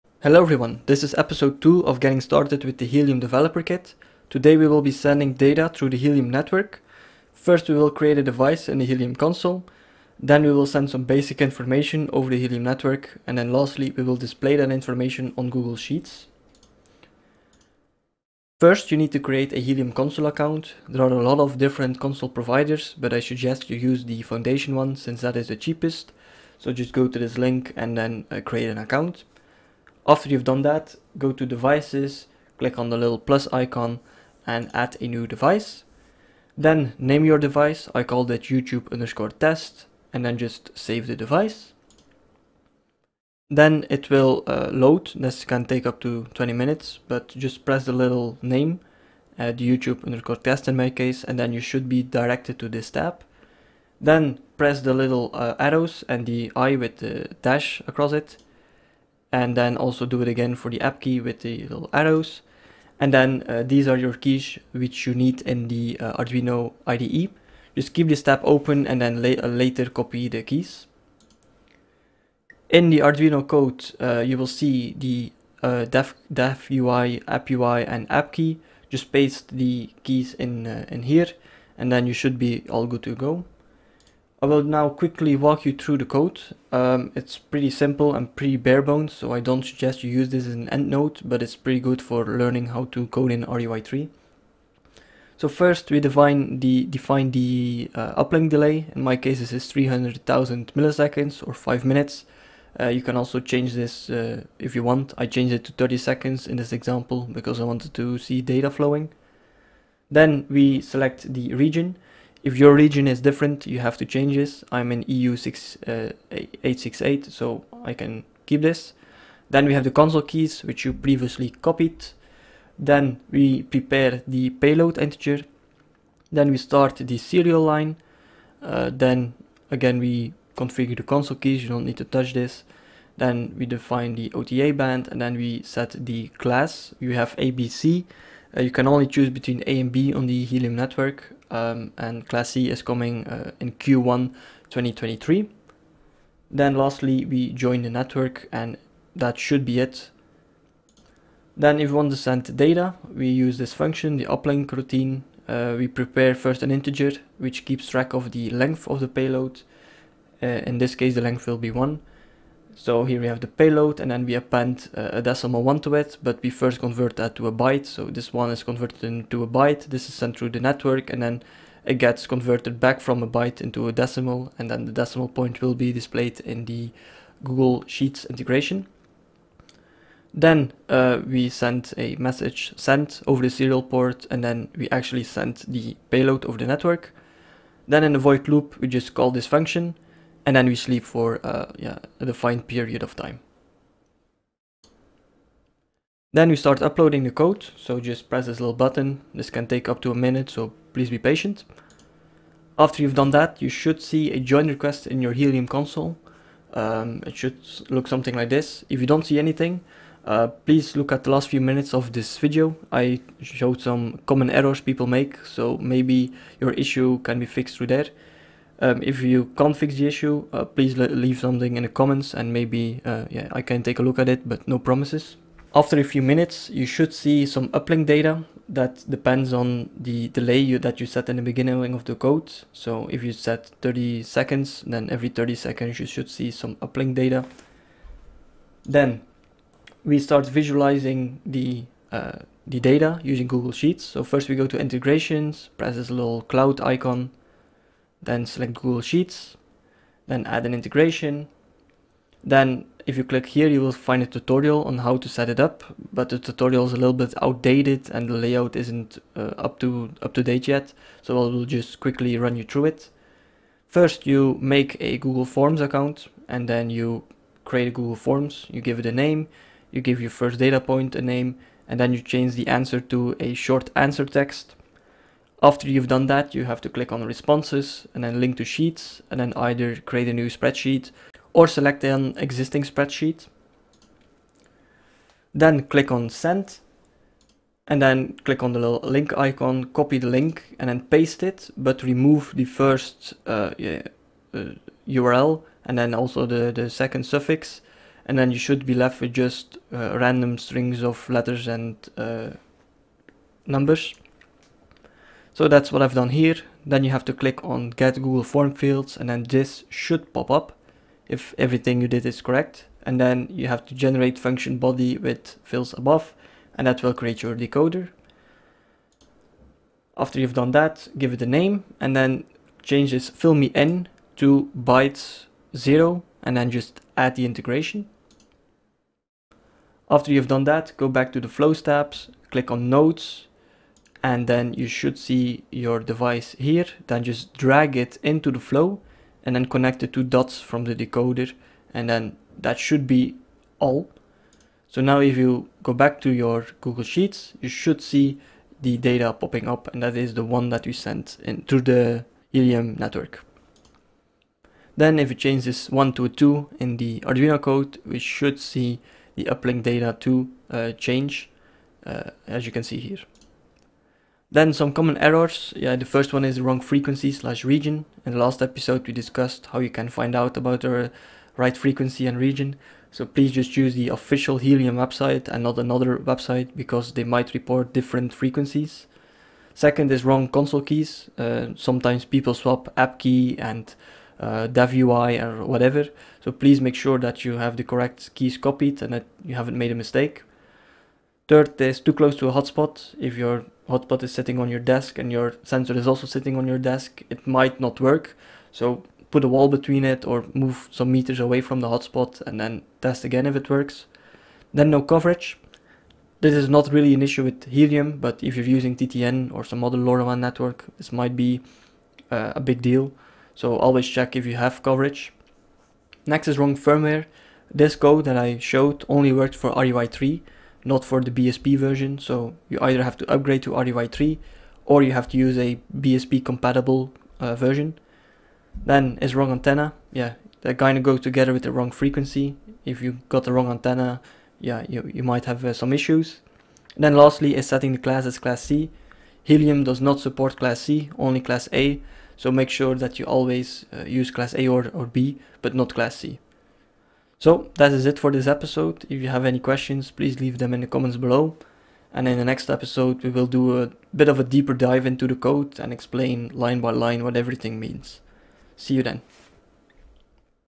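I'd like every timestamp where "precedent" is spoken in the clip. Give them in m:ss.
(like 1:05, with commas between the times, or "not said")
not said.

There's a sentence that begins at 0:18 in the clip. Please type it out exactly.
First you need to create a Helium console account.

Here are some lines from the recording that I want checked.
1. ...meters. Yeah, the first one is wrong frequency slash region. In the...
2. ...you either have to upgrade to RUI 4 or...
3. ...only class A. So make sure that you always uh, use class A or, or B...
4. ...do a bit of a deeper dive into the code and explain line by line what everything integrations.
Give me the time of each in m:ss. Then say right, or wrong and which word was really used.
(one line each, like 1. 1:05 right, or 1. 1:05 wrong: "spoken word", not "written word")
1. 6:05 wrong: "errors", not "meters"
2. 7:02 wrong: "3", not "4"
3. 7:21 right
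4. 7:33 wrong: "means", not "integrations".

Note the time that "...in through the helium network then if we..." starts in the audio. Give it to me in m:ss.
5:51.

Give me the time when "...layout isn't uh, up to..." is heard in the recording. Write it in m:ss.
4:18.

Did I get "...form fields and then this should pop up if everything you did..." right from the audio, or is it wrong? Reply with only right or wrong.
right.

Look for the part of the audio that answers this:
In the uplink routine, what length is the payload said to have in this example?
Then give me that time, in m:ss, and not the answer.
2:41.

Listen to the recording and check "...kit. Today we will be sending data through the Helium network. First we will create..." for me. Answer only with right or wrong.
right.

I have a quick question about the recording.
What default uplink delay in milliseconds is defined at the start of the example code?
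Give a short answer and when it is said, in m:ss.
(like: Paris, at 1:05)
300,000, at 1:39.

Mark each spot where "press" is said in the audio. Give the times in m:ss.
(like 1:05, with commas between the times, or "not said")
0:47, 0:54, 3:18, 4:05.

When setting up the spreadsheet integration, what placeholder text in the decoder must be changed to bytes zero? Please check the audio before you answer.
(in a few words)
fill me in.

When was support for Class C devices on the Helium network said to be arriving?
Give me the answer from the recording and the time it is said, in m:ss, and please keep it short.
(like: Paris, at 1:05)
Q1 2023, at 2:23.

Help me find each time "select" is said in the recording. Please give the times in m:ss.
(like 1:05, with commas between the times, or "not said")
1:50, 4:08, 4:41.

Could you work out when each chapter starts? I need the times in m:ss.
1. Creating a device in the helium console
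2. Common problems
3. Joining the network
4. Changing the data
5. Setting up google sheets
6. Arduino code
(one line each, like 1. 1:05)
1. 0:18
2. 6:05
3. 3:20
4. 5:50
5. 3:59
6. 1:12.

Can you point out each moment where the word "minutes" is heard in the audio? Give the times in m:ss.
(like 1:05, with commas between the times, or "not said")
0:46, 1:41, 3:20, 3:31, 3:46.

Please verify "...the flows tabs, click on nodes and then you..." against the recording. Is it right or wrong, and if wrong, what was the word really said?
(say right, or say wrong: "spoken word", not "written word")
right.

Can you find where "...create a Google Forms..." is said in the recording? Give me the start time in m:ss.
4:27.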